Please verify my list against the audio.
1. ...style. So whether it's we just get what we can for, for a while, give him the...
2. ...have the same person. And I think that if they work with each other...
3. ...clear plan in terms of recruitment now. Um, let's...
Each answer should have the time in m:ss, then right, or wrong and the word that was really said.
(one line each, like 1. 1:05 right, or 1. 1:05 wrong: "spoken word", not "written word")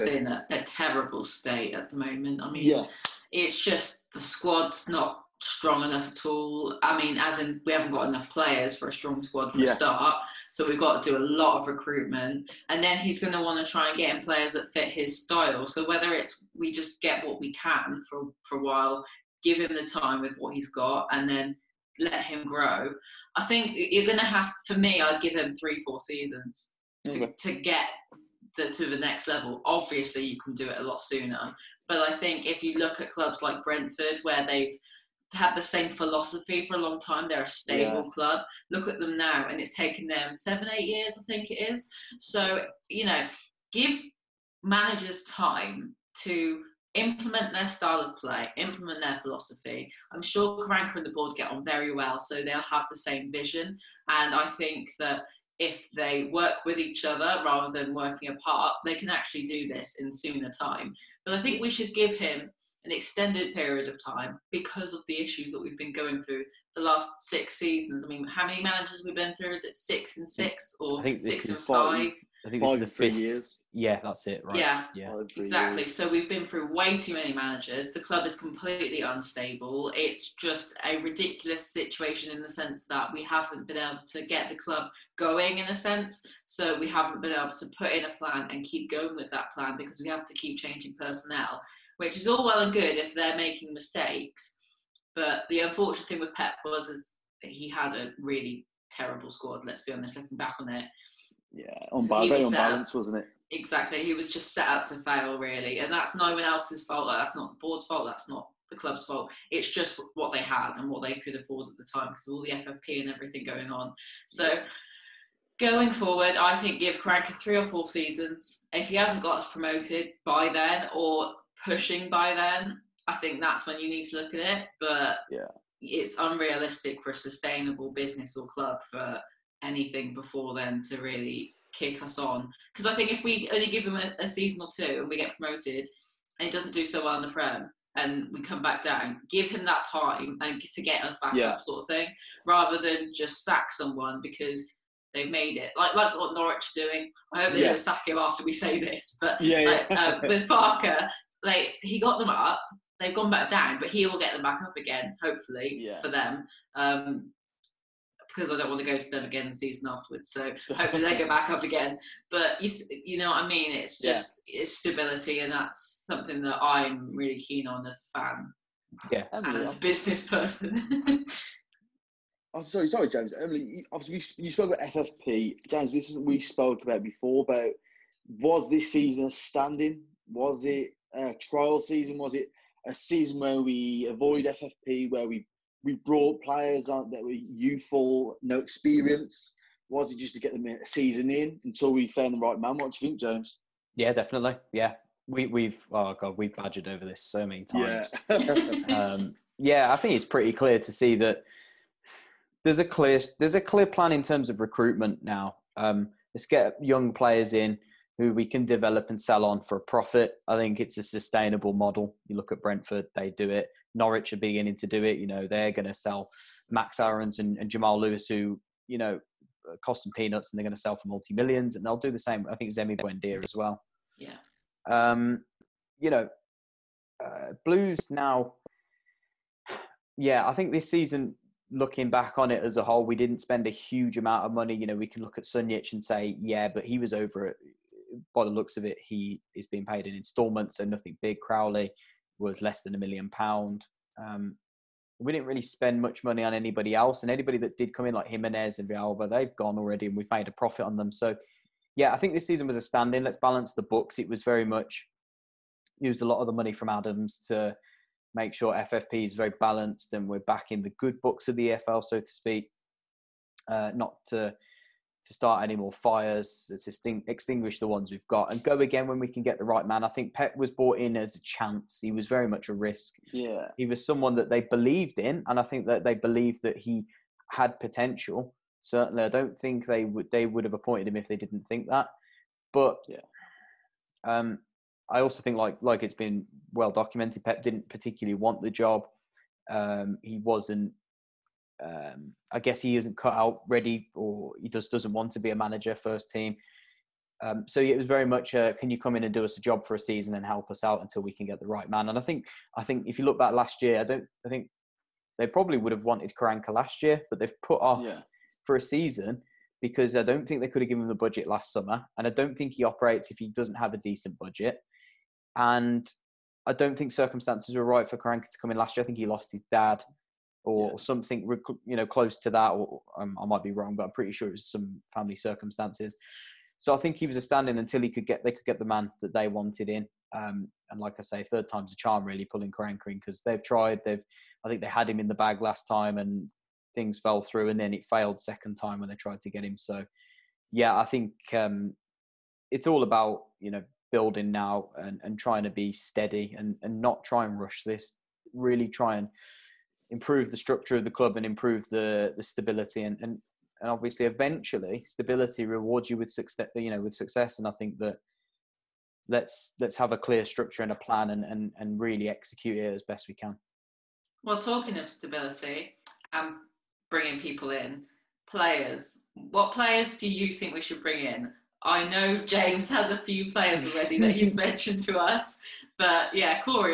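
1. 0:15 right
2. 0:52 wrong: "vision", not "person"
3. 3:23 right.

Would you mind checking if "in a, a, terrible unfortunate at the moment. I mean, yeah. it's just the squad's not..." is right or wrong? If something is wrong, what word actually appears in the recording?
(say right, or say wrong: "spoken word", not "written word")
wrong: "state", not "unfortunate".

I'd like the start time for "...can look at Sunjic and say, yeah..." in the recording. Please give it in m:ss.
3:55.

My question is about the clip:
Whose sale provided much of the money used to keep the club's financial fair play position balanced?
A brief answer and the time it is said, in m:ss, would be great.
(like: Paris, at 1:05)
Adams, at 4:16.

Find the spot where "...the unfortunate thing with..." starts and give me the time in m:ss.
1:35.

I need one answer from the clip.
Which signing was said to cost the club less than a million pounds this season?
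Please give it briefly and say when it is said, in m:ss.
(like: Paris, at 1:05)
Crowley, at 4:01.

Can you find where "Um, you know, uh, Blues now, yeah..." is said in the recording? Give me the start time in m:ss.
3:44.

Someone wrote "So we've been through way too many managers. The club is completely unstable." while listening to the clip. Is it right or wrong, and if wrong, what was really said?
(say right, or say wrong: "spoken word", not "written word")
right.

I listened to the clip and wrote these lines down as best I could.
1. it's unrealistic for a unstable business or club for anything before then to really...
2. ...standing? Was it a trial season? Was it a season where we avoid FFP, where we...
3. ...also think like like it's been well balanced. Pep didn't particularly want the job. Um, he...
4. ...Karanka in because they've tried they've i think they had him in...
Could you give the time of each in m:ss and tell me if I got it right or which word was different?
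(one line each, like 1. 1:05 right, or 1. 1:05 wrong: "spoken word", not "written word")
1. 2:05 wrong: "sustainable", not "unstable"
2. 2:59 right
3. 4:45 wrong: "documented", not "balanced"
4. 5:32 right.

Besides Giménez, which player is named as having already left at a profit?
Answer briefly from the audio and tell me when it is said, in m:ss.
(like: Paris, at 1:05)
Villalba, at 4:08.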